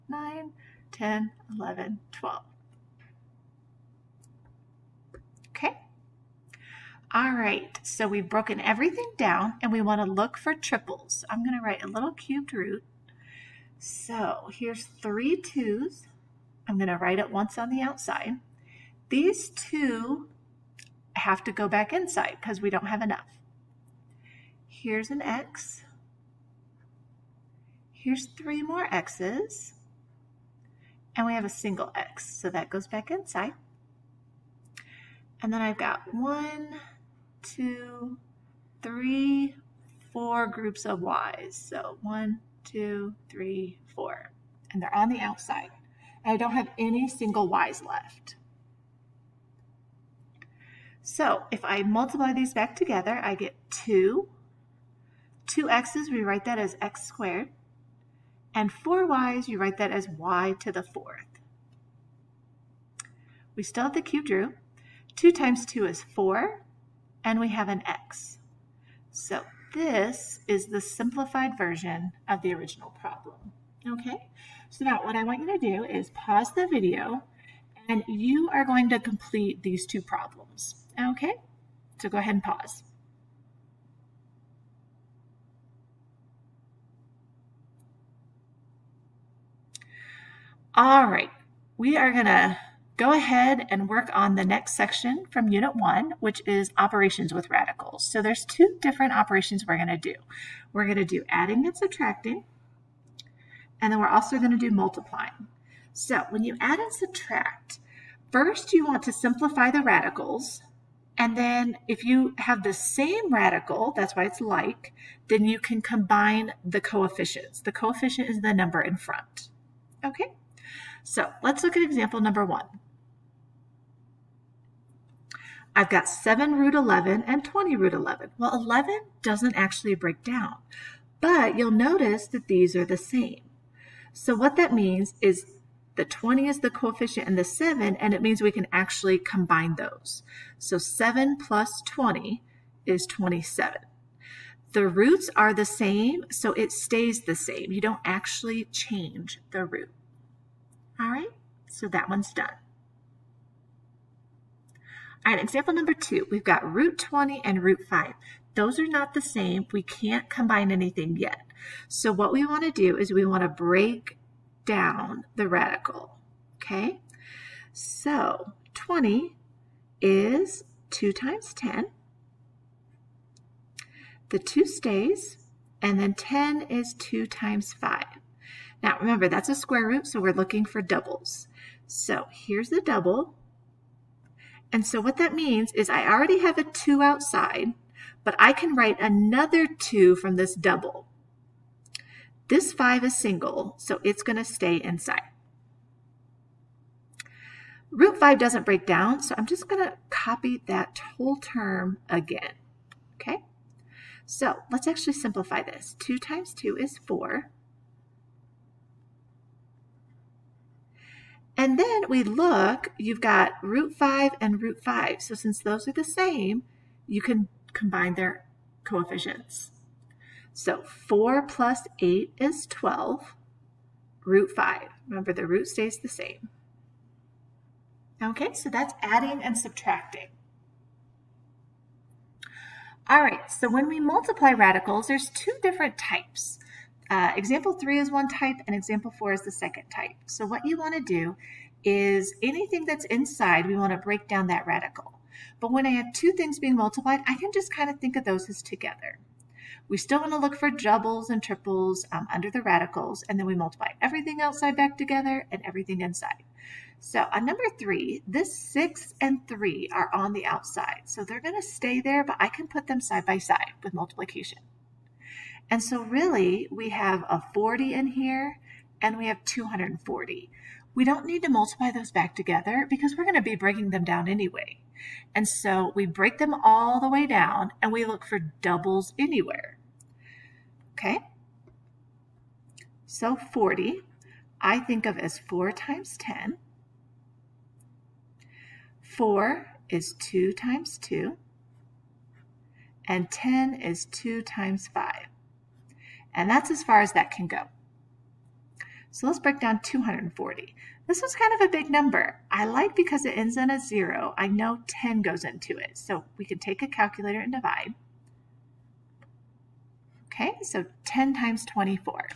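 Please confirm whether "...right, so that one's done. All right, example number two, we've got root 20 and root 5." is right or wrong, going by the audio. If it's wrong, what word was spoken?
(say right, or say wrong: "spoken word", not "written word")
right.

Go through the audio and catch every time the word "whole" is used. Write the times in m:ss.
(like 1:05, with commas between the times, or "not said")
3:21.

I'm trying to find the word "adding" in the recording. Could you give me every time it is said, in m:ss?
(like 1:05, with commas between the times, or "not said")
1:41, 3:49.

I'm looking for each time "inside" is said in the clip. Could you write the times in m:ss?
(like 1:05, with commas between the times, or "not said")
0:21, 0:33, 3:14, 4:03, 4:16.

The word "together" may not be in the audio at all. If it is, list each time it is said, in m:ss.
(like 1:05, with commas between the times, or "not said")
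0:52, 4:08, 4:14, 4:32.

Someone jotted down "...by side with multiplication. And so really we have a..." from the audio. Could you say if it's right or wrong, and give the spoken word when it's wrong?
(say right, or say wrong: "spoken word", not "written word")
right.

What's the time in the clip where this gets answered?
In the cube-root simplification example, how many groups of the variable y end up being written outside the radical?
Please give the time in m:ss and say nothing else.
0:36.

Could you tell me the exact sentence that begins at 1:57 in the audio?
The coefficient is the number in front.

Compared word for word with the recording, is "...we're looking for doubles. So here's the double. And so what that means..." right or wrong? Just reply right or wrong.
right.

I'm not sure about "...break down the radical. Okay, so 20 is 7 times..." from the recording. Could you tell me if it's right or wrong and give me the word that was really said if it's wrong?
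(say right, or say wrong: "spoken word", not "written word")
wrong: "2", not "7".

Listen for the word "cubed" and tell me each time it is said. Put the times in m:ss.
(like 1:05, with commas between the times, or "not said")
0:12, 1:04.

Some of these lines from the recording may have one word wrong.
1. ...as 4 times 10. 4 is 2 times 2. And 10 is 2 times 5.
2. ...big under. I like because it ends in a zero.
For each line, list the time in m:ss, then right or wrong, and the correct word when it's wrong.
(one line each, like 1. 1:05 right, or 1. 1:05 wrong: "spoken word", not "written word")
1. 4:45 right
2. 5:01 wrong: "number", not "under".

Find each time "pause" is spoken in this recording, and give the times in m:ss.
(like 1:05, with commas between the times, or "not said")
1:16, 1:22.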